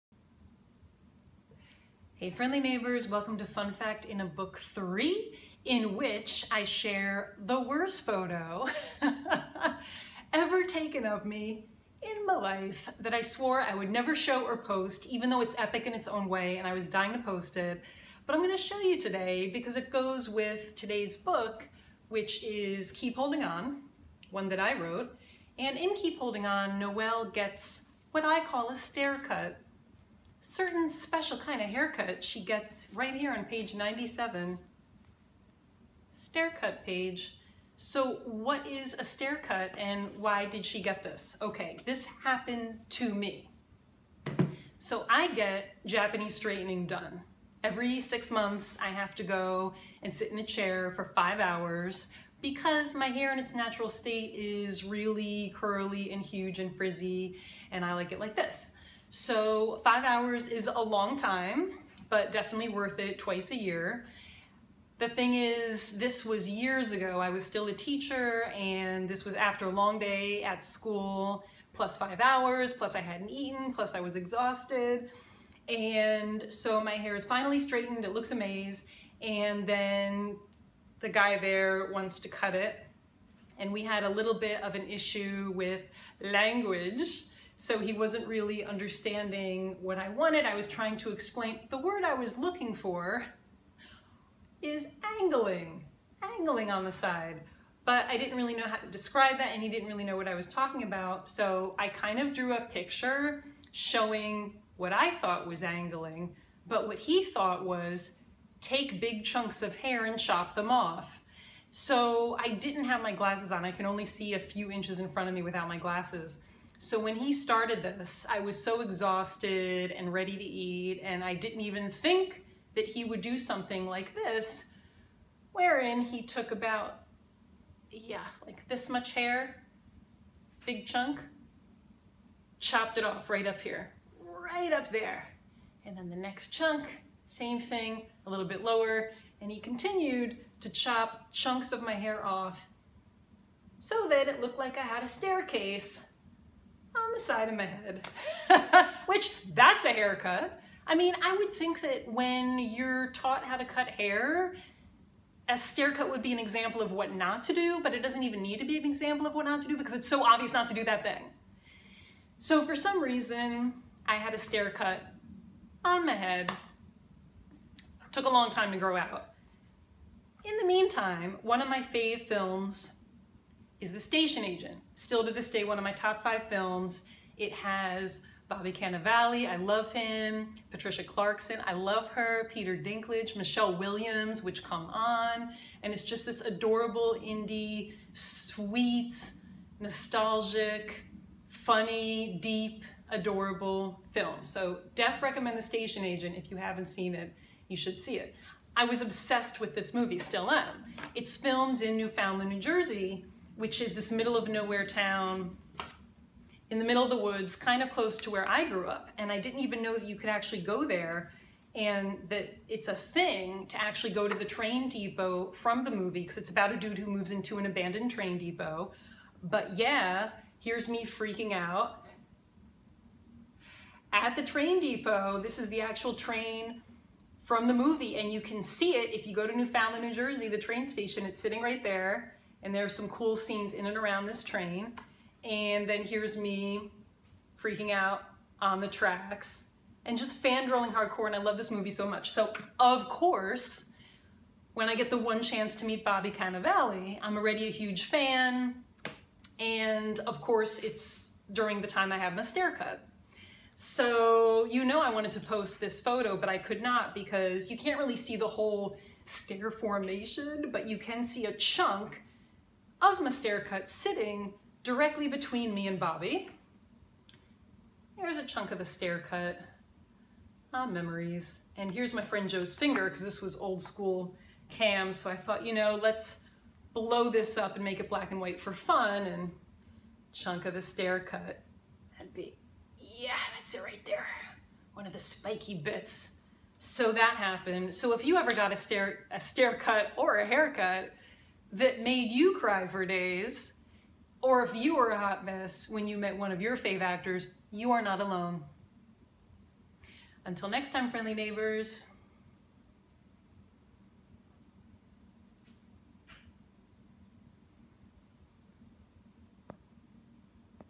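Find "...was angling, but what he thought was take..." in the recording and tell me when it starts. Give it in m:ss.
1:45.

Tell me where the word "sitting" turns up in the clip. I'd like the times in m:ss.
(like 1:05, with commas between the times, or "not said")
3:51, 4:23.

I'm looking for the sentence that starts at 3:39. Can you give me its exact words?
But yeah, here's me freaking out.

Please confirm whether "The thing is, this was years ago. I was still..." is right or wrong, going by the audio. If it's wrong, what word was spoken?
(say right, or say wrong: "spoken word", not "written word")
right.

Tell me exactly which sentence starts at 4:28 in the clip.
Here's a chunk of the stair cut.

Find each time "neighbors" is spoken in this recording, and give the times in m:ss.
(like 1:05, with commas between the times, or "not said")
0:02, 5:01.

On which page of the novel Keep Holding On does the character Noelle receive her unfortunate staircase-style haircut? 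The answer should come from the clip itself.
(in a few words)
97.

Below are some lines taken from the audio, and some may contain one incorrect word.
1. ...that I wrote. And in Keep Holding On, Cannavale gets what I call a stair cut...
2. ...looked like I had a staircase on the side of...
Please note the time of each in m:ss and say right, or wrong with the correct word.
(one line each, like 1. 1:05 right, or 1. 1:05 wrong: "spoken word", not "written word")
1. 0:24 wrong: "Noelle", not "Cannavale"
2. 2:24 right.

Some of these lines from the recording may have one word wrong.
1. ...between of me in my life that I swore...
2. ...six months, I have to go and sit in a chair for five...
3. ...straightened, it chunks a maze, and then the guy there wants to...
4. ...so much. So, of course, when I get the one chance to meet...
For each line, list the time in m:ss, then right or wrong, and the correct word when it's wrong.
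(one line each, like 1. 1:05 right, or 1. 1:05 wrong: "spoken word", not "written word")
1. 0:10 wrong: "taken", not "between"
2. 0:47 right
3. 1:17 wrong: "looks", not "chunks"
4. 4:01 right.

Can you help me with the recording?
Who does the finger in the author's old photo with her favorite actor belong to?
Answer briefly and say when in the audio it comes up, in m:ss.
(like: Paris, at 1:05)
Joe, at 4:32.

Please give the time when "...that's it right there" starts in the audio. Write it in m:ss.
4:43.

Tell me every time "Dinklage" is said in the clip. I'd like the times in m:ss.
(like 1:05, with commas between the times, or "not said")
3:02.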